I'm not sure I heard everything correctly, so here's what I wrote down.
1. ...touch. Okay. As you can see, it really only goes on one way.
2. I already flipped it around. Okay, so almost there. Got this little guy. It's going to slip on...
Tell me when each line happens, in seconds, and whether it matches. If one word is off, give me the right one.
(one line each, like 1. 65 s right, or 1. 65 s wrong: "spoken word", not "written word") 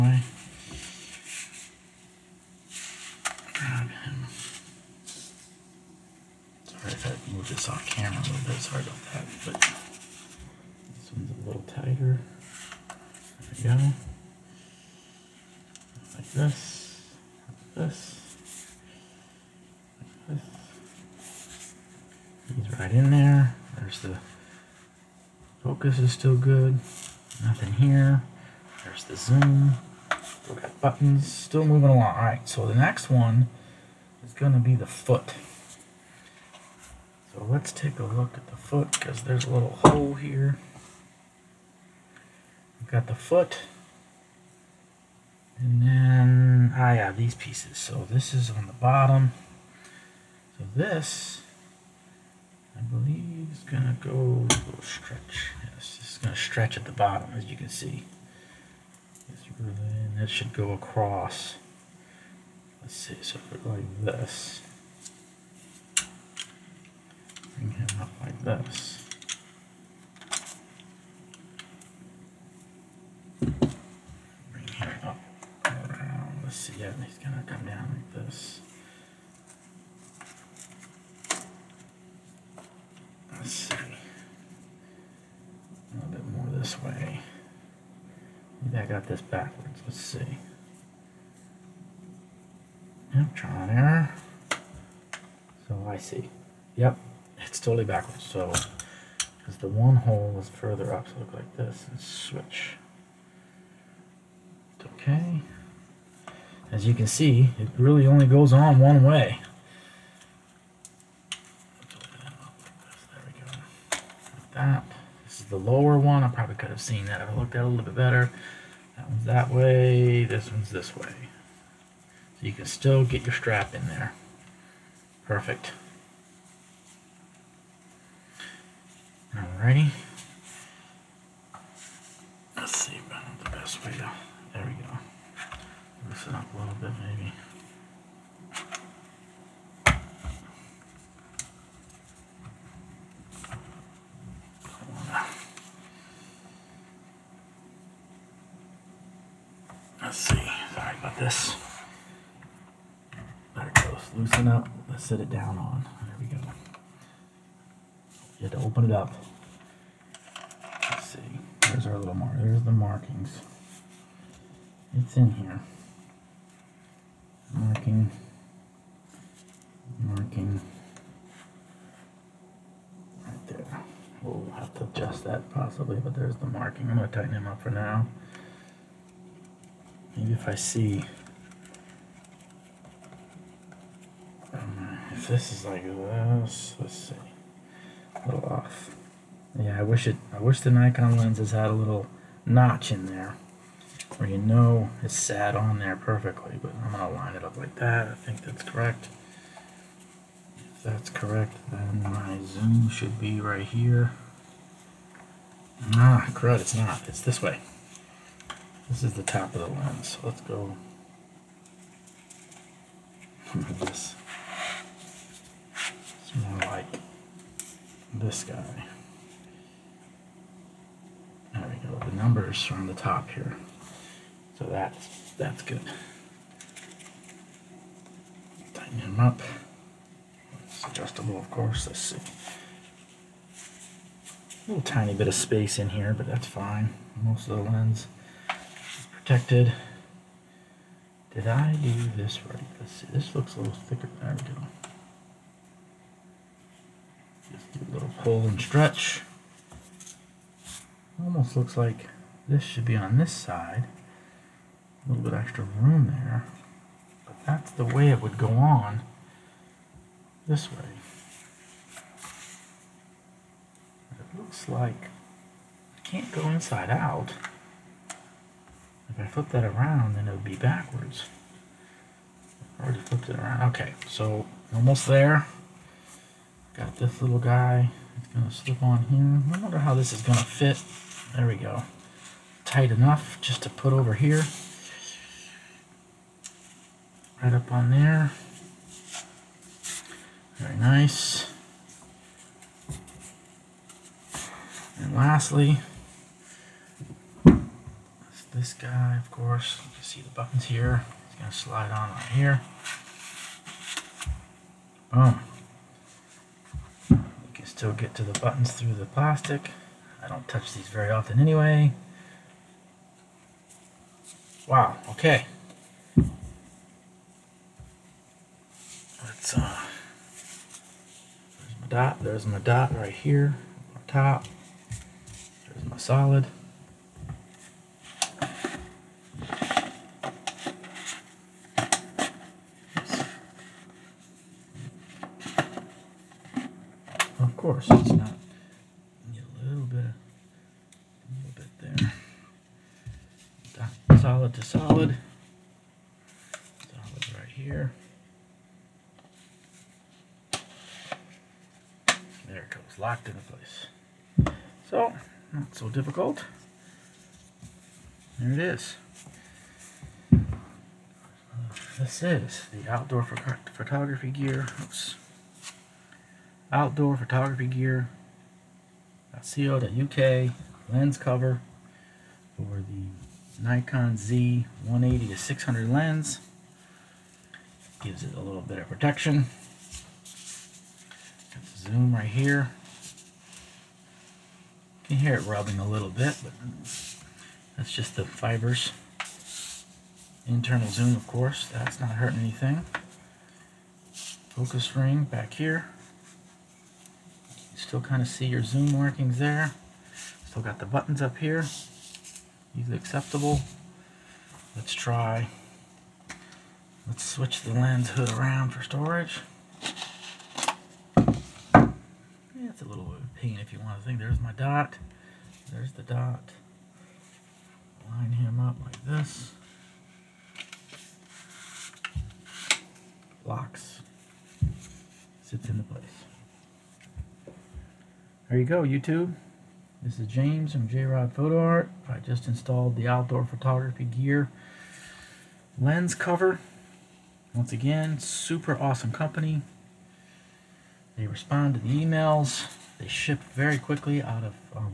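1. 101 s wrong: "switch", not "touch"
2. 272 s right.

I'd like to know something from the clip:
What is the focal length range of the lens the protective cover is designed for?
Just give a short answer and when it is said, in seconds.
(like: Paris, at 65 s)
180 to 600, at 374 s.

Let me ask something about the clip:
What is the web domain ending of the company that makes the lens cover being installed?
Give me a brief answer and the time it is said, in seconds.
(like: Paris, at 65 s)
.co.uk, at 369 s.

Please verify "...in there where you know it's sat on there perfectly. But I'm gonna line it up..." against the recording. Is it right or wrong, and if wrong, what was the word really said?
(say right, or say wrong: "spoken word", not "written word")
right.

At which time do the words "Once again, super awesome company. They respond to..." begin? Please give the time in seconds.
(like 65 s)
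437 s.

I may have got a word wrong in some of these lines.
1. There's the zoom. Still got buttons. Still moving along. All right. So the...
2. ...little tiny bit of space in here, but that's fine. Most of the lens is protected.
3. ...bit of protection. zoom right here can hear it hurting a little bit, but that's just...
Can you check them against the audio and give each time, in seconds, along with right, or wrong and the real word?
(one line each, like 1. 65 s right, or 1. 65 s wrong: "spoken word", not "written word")
1. 28 s right
2. 234 s right
3. 378 s wrong: "rubbing", not "hurting".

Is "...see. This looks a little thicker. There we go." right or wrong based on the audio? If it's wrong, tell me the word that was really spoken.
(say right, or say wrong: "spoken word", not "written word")
right.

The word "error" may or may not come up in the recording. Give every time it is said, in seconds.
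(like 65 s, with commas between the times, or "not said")
93 s.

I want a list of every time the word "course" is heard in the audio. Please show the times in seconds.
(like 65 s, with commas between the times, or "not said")
231 s, 299 s, 391 s.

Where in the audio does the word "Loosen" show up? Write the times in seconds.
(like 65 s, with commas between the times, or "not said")
136 s, 154 s.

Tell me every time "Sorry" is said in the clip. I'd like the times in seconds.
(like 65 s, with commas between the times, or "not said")
8 s, 150 s.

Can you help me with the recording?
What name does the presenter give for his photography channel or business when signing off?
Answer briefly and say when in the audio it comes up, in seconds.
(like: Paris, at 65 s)
J-Rod Photo Art, at 430 s.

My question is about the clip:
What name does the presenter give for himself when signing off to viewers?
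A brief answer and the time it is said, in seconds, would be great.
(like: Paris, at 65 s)
James, at 430 s.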